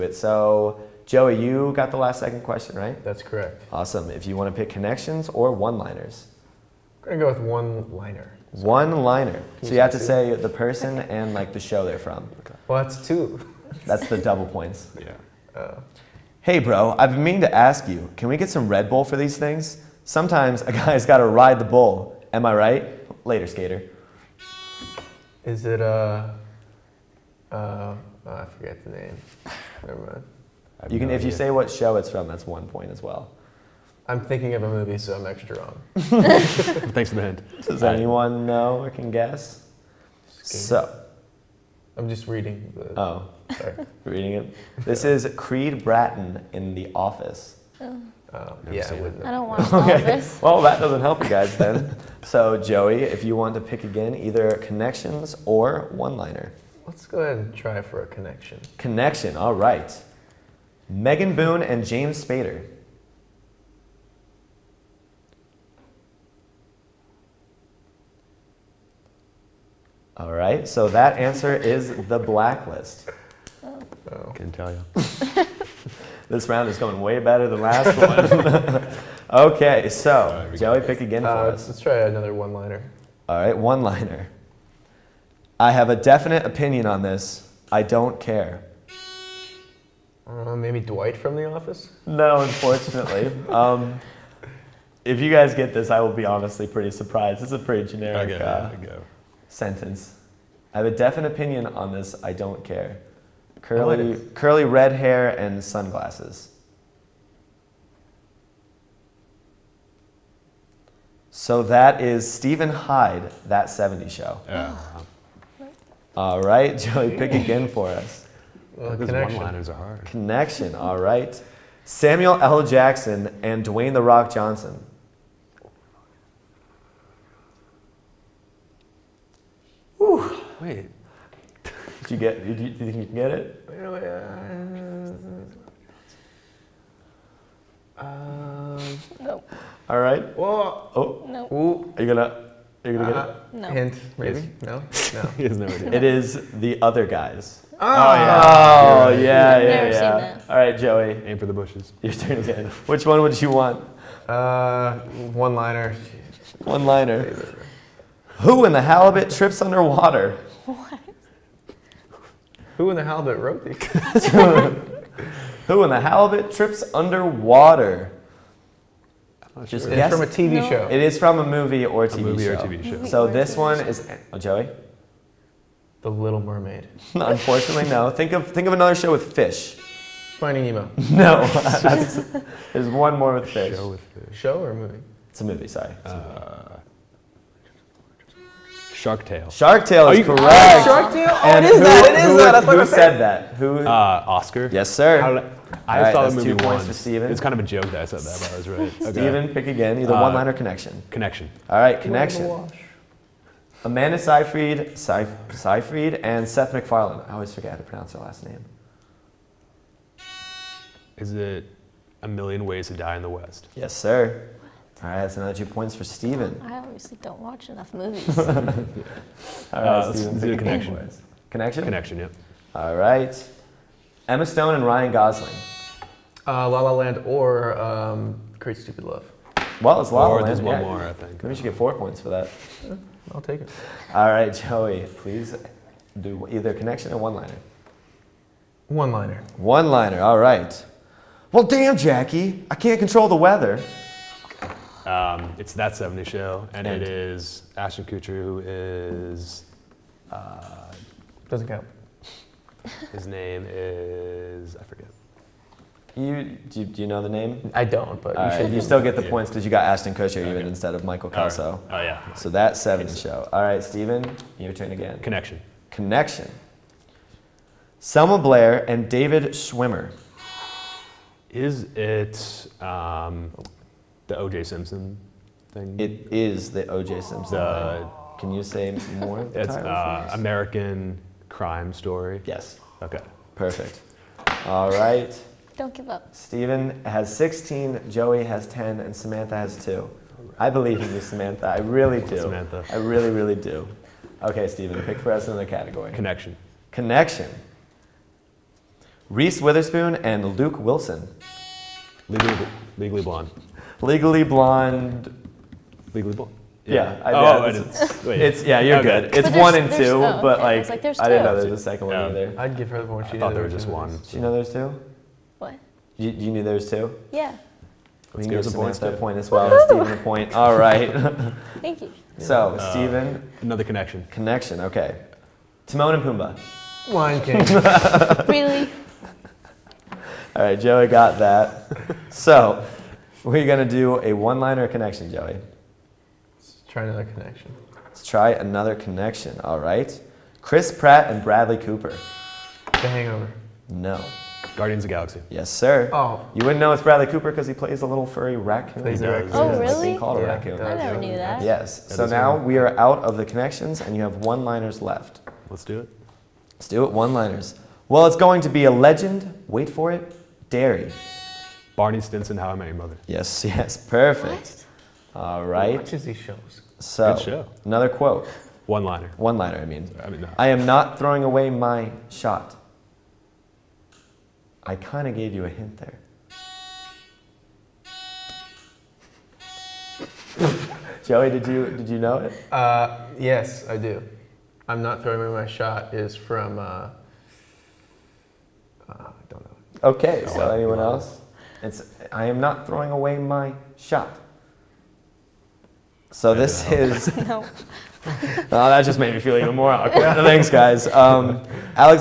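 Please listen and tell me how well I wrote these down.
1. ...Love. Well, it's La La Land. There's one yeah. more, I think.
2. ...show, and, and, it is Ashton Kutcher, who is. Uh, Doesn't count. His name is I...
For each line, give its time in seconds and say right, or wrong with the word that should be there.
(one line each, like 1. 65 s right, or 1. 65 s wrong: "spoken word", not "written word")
1. 229 s right
2. 246 s right.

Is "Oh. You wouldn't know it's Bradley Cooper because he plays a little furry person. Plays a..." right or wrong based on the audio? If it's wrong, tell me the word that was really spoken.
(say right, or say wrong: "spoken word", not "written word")
wrong: "raccoon", not "person".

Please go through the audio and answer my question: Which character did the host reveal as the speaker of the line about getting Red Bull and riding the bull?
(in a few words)
Creed Bratton.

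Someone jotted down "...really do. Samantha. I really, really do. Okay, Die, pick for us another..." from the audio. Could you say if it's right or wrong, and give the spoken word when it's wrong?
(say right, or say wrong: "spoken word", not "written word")
wrong: "Steven", not "Die".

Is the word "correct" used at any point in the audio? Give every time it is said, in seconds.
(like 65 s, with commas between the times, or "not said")
3 s, 190 s.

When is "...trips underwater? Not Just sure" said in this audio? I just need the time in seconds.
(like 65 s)
166 s.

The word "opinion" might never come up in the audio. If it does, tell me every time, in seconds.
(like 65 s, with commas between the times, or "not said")
86 s, 101 s.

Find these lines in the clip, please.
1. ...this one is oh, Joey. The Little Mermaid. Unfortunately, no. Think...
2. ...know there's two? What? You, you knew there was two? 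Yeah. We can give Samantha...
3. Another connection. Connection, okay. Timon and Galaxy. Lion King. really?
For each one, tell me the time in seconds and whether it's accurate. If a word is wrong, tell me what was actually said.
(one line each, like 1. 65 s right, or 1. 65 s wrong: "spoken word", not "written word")
1. 173 s right
2. 314 s right
3. 323 s wrong: "Pumbaa", not "Galaxy".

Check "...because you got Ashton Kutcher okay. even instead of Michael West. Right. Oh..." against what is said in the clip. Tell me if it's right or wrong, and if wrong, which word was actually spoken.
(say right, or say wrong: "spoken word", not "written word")
wrong: "Kelso", not "West".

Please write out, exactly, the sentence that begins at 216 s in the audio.
I obviously don't watch enough movies.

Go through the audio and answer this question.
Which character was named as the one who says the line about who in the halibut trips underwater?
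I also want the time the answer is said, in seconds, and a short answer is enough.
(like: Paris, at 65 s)
Oscar, at 194 s.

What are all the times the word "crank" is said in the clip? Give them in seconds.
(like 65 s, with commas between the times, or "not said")
not said.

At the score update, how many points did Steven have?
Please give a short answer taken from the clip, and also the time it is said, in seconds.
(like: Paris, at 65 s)
16, at 287 s.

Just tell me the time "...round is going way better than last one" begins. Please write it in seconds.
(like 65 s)
76 s.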